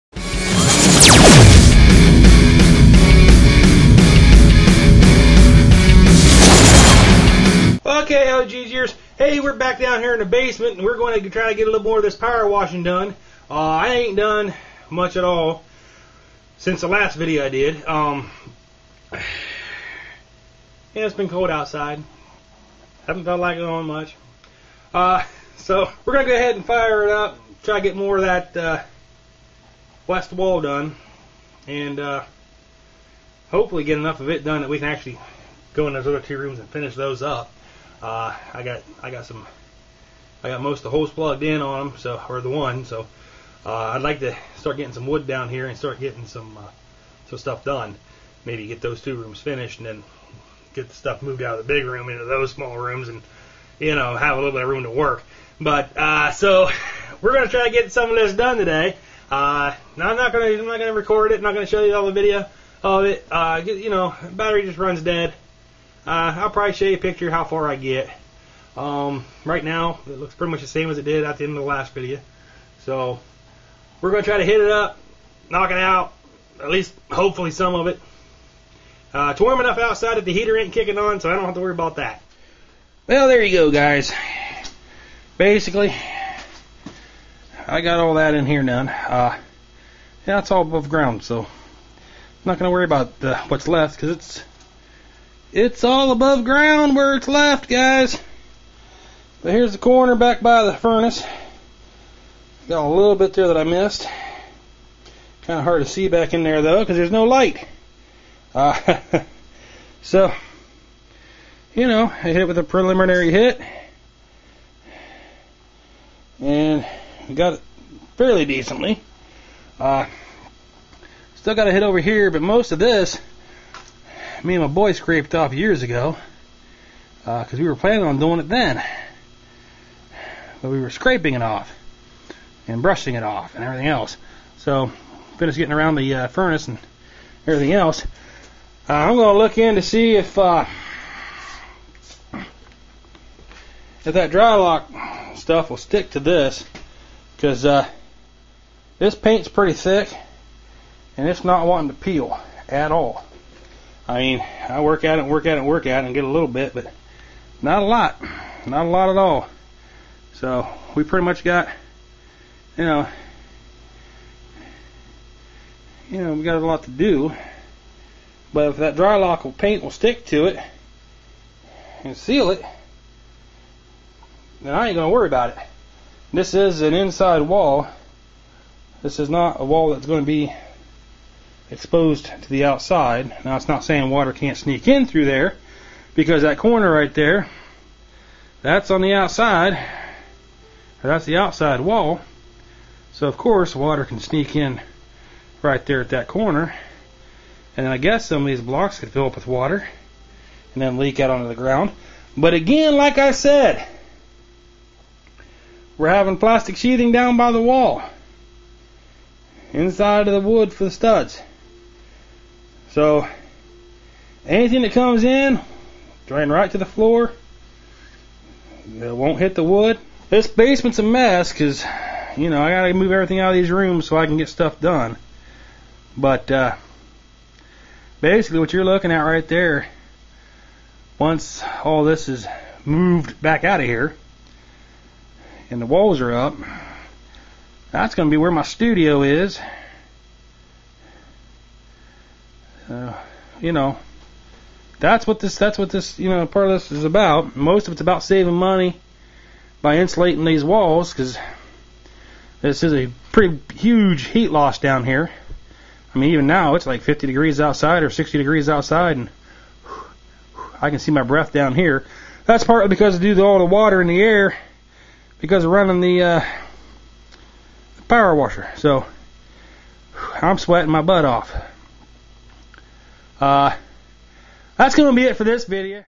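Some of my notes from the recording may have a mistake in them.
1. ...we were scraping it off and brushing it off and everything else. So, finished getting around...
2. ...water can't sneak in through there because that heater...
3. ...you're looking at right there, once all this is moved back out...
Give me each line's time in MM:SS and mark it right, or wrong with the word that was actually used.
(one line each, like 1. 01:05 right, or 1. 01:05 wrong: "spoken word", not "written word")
1. 02:10 right
2. 03:04 wrong: "corner", not "heater"
3. 03:48 right.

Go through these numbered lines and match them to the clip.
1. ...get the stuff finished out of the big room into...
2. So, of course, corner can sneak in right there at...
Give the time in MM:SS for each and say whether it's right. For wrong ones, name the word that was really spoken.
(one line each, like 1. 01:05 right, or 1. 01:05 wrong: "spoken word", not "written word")
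1. 00:50 wrong: "moved", not "finished"
2. 03:13 wrong: "water", not "corner".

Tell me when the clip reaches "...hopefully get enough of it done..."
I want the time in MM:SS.
00:33.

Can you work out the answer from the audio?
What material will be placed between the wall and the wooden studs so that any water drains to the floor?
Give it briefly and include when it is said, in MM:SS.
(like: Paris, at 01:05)
Plastic sheathing, at 03:26.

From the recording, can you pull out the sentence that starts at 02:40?
So we pretty much got, you know, you know, we got a lot to do.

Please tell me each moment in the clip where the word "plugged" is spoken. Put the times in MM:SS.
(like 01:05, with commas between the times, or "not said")
00:41.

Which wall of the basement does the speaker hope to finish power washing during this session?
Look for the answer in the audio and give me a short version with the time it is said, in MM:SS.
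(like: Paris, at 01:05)
West wall, at 00:30.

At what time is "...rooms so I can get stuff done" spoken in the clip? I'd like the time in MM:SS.
03:43.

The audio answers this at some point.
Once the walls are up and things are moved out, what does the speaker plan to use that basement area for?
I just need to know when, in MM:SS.
03:58.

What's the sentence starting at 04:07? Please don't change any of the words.
Most of it's about saving money by insulating these walls because this is a pretty huge heat loss down here.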